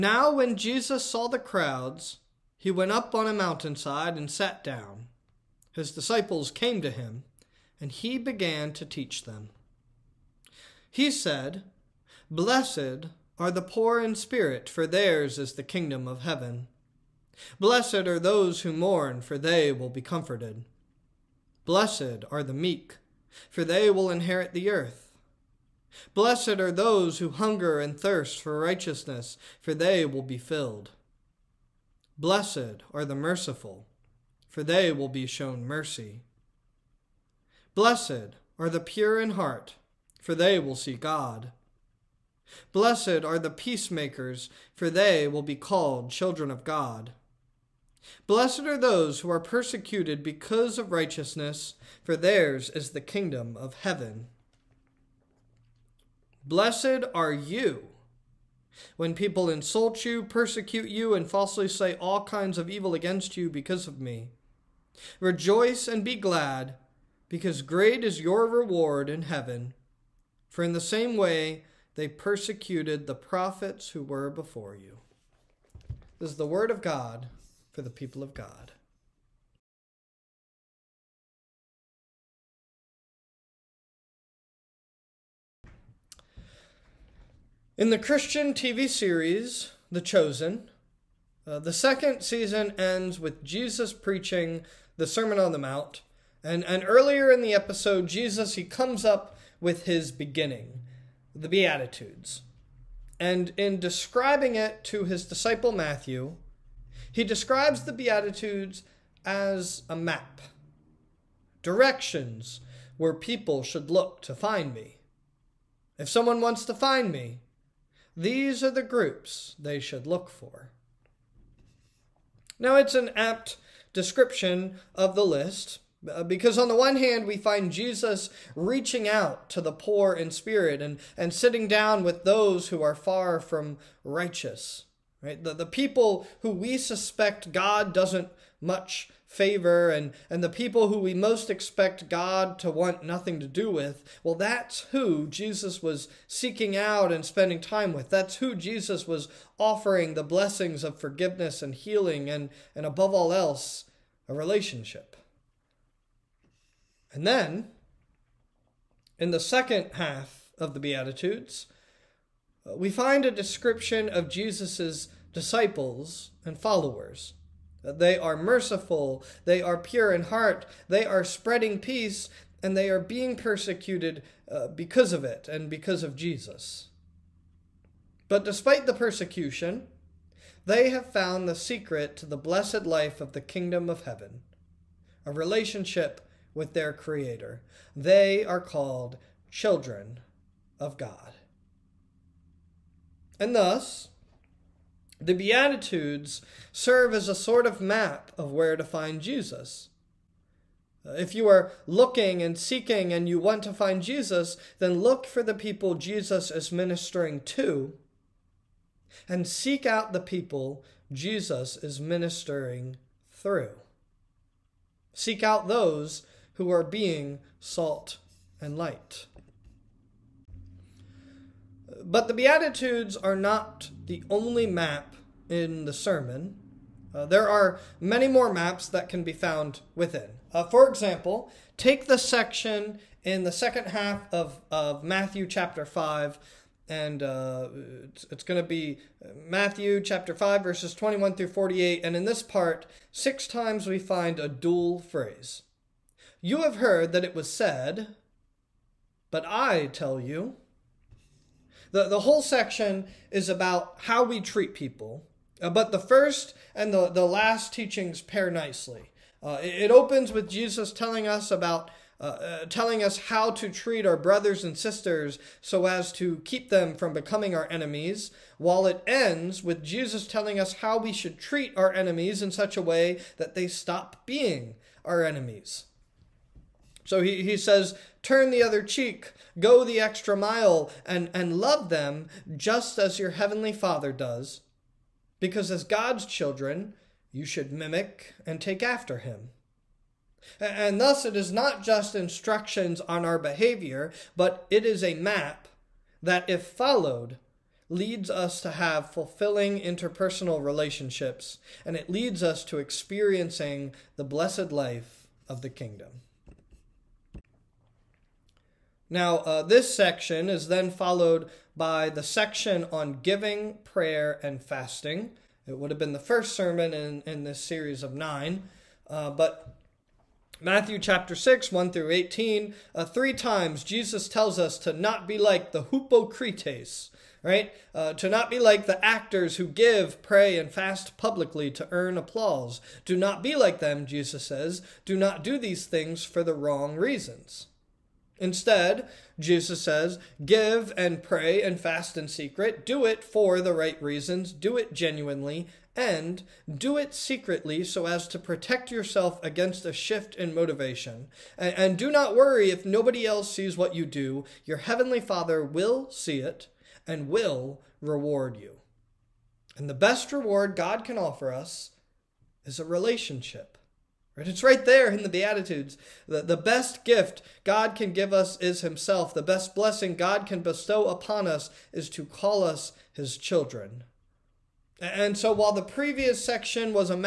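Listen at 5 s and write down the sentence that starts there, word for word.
His disciples came to him, and he began to teach them.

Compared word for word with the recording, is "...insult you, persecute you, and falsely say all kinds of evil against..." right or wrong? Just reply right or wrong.
right.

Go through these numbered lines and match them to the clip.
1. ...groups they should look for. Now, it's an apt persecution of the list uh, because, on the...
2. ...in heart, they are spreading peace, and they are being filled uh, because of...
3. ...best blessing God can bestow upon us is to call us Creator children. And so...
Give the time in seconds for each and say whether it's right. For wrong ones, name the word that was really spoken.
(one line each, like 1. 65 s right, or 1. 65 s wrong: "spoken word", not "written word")
1. 118 s wrong: "description", not "persecution"
2. 170 s wrong: "persecuted", not "filled"
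3. 369 s wrong: "His", not "Creator".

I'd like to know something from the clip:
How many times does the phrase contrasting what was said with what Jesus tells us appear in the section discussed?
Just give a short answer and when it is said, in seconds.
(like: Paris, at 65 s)
6, at 243 s.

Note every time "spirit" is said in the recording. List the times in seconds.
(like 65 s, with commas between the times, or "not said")
14 s, 130 s.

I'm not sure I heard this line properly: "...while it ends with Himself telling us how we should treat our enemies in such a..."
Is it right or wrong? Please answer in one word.
wrong.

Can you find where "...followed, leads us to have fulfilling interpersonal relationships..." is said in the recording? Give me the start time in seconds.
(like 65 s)
296 s.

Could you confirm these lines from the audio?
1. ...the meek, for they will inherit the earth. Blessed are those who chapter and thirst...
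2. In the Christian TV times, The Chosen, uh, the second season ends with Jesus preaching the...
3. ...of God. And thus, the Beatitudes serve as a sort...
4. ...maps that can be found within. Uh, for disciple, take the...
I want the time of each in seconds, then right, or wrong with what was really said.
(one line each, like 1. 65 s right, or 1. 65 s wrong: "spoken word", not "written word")
1. 22 s wrong: "hunger", not "chapter"
2. 87 s wrong: "series", not "times"
3. 190 s right
4. 228 s wrong: "example", not "disciple".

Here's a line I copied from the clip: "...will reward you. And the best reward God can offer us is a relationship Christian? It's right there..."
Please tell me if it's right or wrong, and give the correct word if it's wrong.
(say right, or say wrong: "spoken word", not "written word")
wrong: "Right", not "Christian".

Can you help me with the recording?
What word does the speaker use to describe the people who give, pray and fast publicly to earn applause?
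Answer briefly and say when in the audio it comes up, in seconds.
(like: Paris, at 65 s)
actors, at 329 s.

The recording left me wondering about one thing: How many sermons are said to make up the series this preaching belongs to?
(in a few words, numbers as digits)
9.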